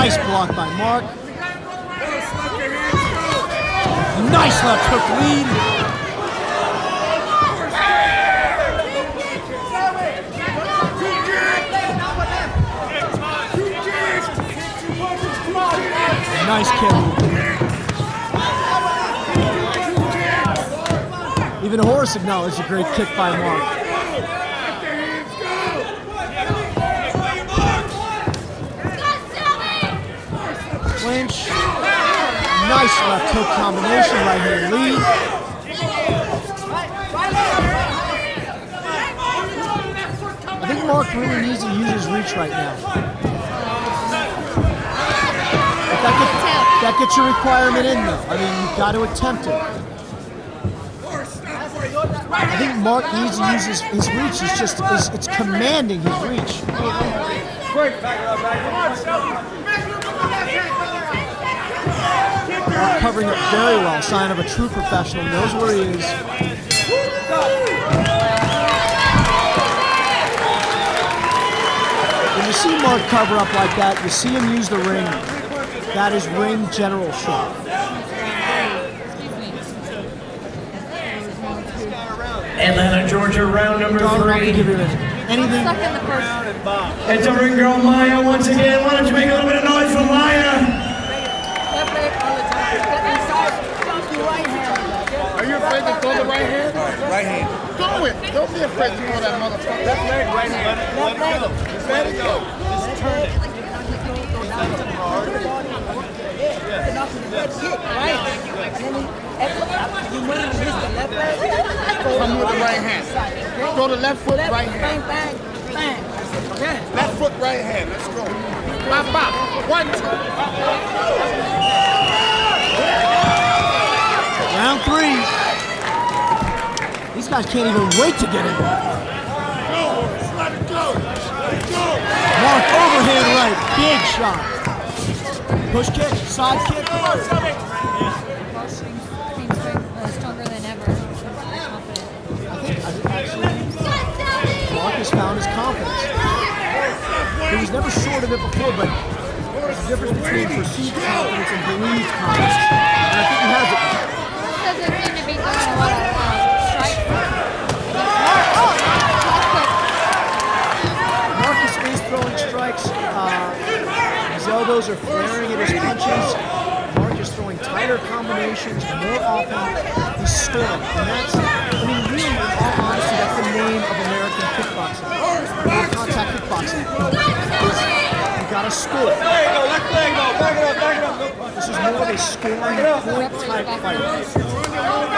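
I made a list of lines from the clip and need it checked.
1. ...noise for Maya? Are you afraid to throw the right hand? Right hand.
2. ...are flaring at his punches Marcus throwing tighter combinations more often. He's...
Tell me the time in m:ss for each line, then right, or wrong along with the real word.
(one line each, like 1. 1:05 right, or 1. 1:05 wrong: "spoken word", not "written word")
1. 1:29 right
2. 2:44 right.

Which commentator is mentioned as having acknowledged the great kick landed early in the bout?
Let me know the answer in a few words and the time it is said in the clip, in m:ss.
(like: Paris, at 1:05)
Horace, at 0:21.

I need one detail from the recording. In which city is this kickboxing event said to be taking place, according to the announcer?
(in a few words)
Atlanta, Georgia.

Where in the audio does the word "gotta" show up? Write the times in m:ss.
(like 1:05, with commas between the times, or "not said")
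2:58.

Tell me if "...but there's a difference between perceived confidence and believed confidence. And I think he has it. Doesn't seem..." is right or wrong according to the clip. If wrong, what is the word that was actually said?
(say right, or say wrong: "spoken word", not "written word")
right.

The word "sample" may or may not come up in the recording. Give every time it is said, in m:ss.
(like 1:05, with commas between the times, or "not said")
not said.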